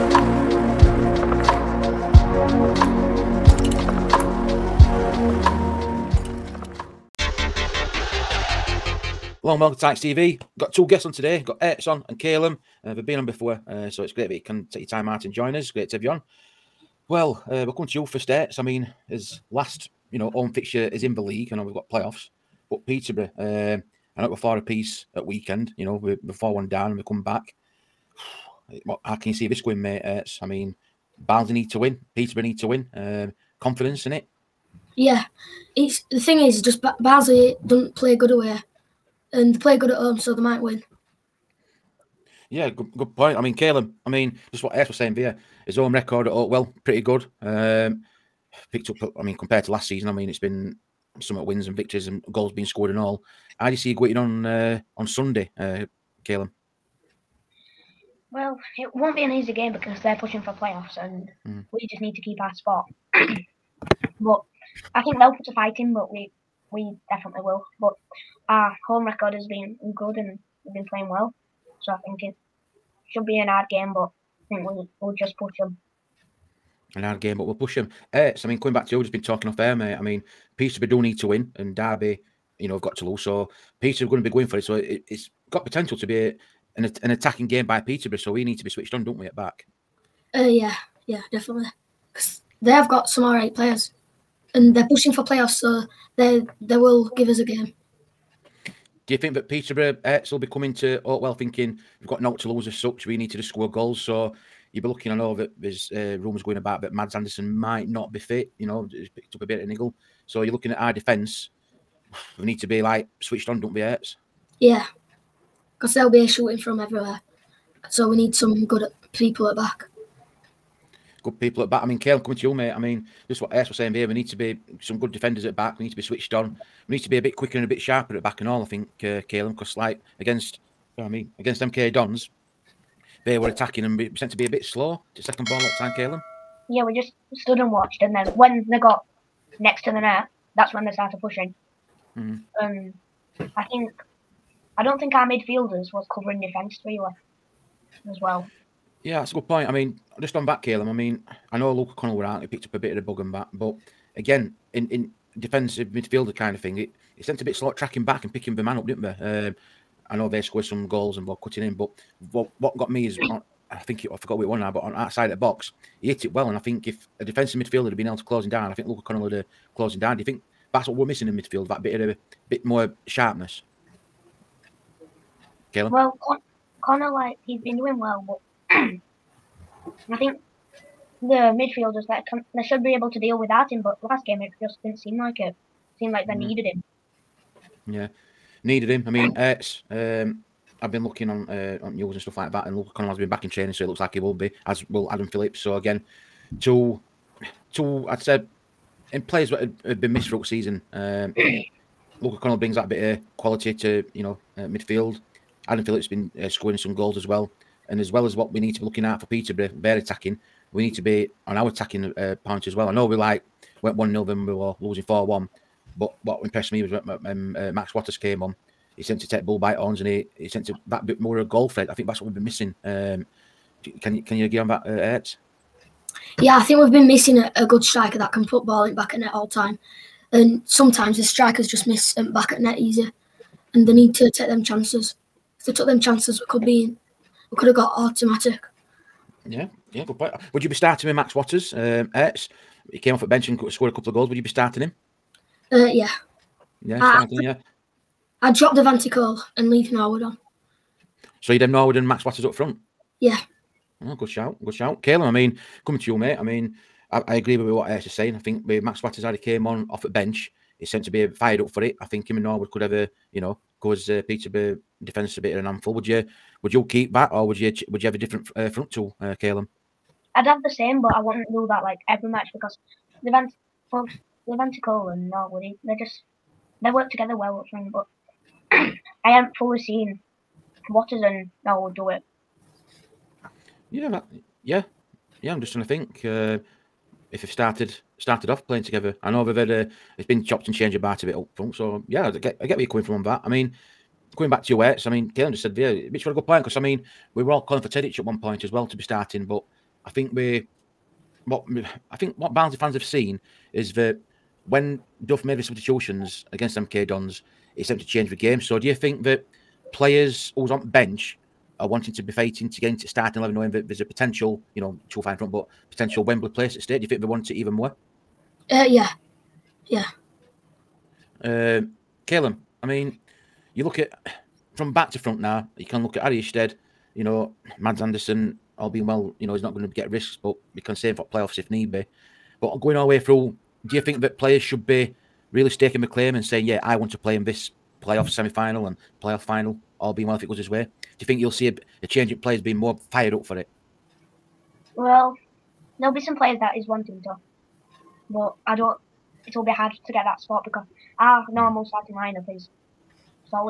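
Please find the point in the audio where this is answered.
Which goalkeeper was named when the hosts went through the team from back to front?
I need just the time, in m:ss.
5:26.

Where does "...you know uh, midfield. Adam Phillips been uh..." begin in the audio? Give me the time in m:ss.
3:24.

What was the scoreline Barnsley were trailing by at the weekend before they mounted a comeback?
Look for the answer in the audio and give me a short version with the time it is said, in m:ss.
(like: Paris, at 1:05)
4-1, at 0:26.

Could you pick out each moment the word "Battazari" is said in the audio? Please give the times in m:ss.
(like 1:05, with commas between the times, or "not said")
4:18.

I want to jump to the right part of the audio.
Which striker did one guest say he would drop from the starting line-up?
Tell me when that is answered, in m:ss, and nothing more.
4:08.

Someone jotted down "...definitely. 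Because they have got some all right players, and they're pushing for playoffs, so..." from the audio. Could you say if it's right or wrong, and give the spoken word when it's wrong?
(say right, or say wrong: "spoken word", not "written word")
right.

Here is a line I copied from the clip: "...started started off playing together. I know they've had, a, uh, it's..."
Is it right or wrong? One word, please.
right.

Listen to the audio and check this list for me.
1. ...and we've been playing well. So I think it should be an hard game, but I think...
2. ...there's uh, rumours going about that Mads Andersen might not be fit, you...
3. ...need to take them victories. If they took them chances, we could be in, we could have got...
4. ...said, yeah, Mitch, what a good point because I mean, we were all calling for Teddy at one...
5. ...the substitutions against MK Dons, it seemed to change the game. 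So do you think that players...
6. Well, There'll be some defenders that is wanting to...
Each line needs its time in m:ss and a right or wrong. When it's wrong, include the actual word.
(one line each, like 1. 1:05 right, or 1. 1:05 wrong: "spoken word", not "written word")
1. 1:10 right
2. 1:45 right
3. 3:53 wrong: "chances", not "victories"
4. 4:55 right
5. 5:05 right
6. 5:44 wrong: "players", not "defenders".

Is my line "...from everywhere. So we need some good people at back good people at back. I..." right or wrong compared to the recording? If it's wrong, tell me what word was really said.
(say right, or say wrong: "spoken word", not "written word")
right.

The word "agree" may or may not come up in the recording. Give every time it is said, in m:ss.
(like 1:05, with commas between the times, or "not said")
3:44, 4:17.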